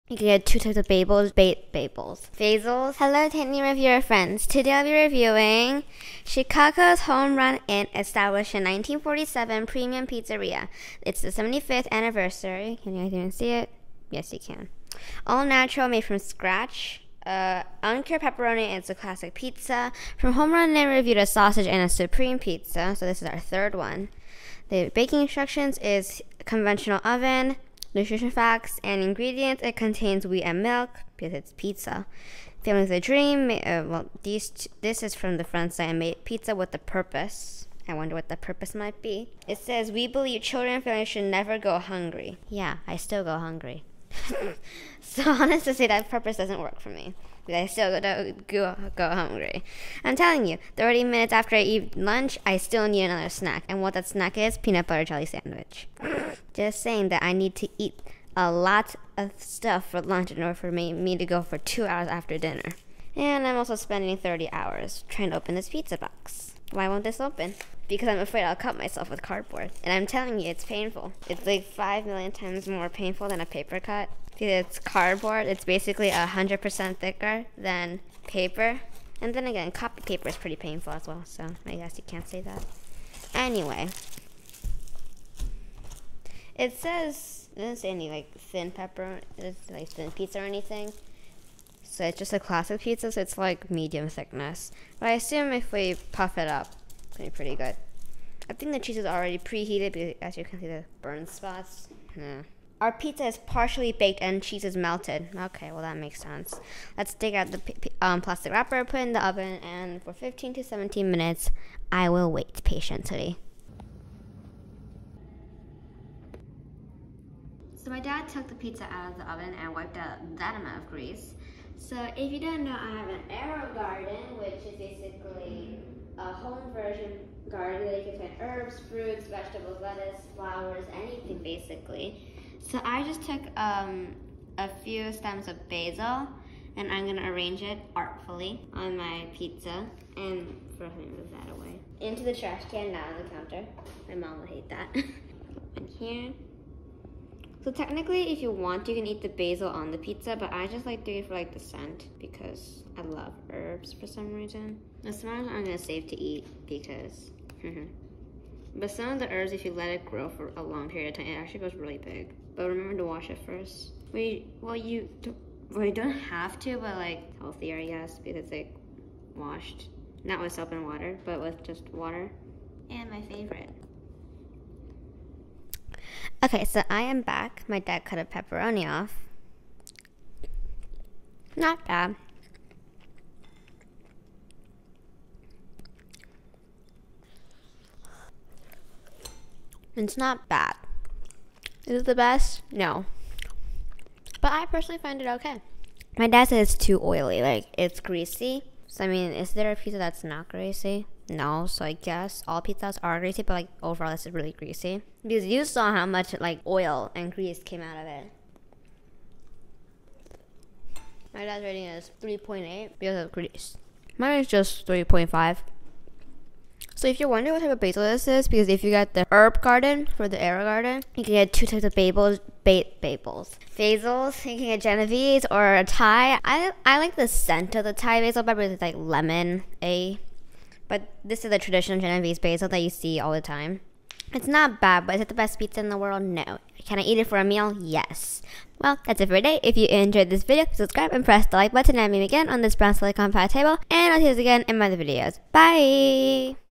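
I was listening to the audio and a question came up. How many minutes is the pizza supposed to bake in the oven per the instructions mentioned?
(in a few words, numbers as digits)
15 to 17.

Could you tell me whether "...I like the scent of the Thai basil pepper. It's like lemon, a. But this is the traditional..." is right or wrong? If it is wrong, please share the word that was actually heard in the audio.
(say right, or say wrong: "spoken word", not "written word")
right.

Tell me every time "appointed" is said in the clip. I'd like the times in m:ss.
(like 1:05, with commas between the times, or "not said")
not said.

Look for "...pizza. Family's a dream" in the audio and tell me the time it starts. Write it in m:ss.
0:31.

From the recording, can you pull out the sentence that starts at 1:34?
But I assume if we puff it up, it's gonna be pretty good.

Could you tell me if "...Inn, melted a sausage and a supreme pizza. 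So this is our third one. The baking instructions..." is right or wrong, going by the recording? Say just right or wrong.
wrong.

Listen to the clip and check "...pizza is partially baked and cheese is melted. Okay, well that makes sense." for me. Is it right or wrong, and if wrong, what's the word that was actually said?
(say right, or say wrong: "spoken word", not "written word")
right.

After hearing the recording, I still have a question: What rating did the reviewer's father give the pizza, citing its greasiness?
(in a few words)
3.8.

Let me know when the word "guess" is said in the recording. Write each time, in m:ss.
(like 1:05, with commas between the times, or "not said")
1:21, 3:21.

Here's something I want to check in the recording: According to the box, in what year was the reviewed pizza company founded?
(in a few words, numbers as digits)
1947.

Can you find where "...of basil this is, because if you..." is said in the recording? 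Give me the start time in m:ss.
3:37.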